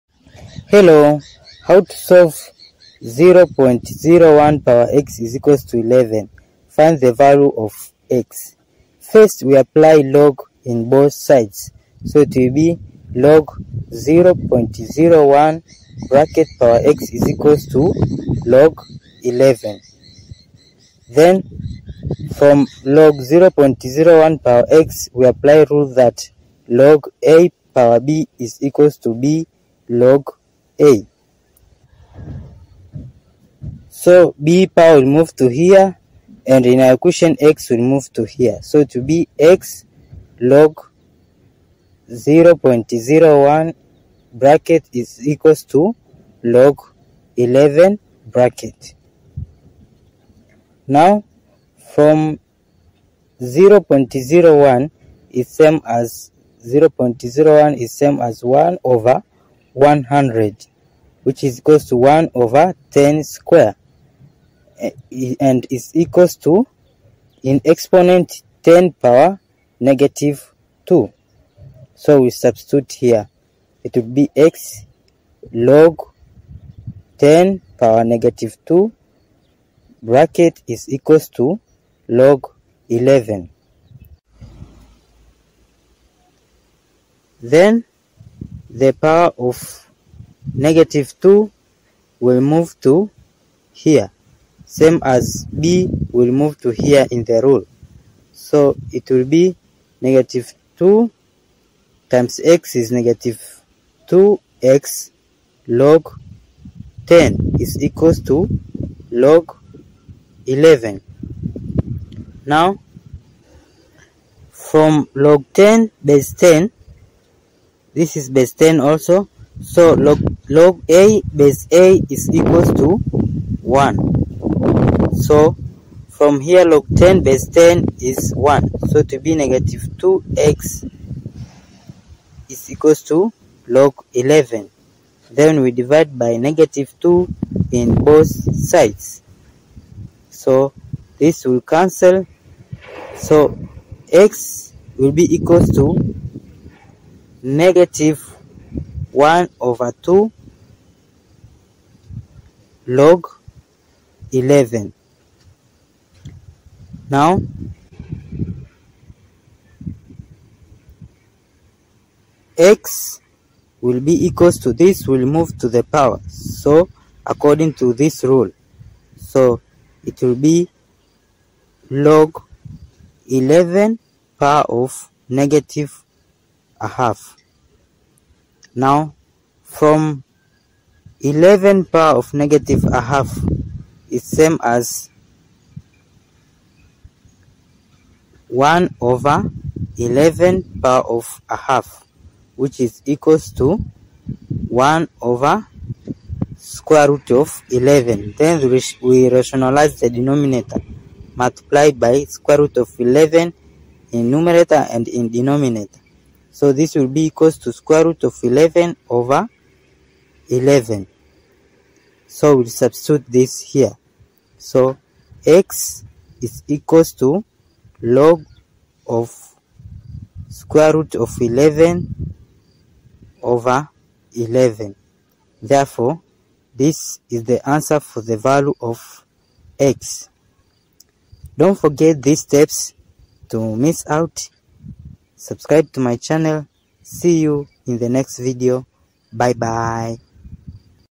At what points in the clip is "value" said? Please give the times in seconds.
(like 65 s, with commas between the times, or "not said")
7 s, 228 s.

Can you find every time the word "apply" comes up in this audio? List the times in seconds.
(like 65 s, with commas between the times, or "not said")
9 s, 25 s.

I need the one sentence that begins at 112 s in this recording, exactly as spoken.
Now, from log 10 base 10, this is base 10 also, so log, log A base A is equals to 1.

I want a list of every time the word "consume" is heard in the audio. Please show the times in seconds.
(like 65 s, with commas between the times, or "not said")
not said.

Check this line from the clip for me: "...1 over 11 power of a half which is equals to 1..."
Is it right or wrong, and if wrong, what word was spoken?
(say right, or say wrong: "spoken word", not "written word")
right.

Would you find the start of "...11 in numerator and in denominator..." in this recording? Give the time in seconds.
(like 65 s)
202 s.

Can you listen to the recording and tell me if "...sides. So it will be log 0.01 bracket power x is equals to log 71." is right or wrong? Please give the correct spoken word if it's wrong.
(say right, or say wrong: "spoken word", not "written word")
wrong: "11", not "71".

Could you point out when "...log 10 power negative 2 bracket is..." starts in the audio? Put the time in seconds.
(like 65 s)
75 s.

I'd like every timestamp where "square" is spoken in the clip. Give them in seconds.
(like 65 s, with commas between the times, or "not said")
63 s, 196 s, 202 s, 207 s, 220 s.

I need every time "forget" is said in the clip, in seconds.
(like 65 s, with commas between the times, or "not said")
231 s.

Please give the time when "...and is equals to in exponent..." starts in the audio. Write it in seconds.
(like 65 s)
65 s.